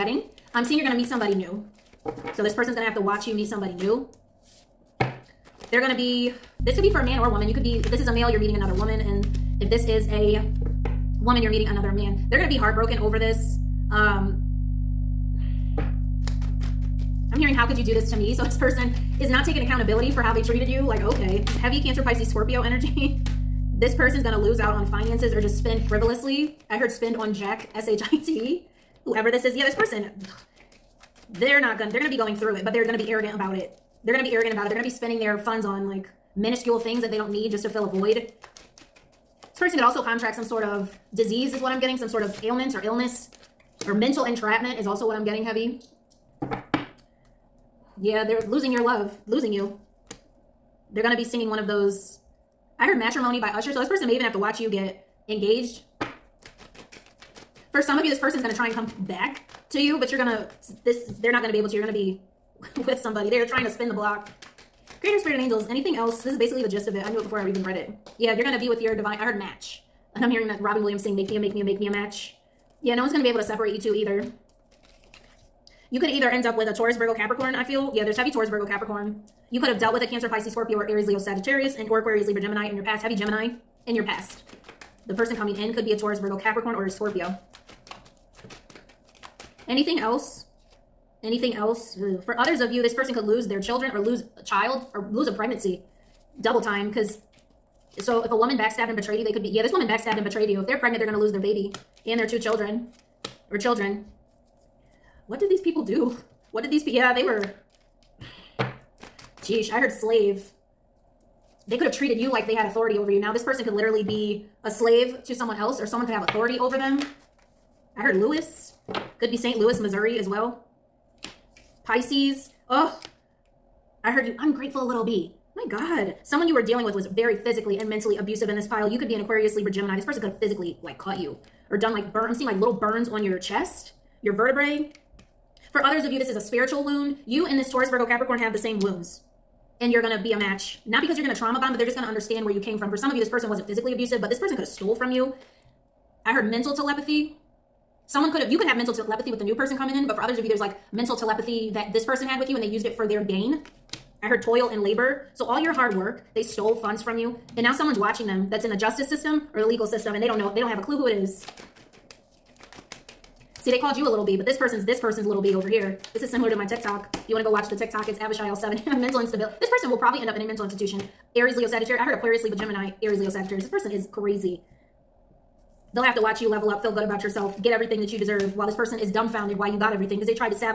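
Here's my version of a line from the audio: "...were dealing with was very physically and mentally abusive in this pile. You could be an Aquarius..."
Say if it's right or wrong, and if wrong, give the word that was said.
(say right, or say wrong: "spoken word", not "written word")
right.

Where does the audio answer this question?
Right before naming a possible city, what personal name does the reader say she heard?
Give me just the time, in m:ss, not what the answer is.
1:58.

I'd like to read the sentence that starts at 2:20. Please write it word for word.
Not because you're going to trauma bond, but they're just going to understand where you came from.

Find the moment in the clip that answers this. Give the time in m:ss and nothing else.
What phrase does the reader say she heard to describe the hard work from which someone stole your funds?
2:34.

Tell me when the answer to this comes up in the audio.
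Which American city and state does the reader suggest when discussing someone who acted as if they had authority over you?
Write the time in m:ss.
1:59.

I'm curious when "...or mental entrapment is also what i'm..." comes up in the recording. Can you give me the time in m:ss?
0:43.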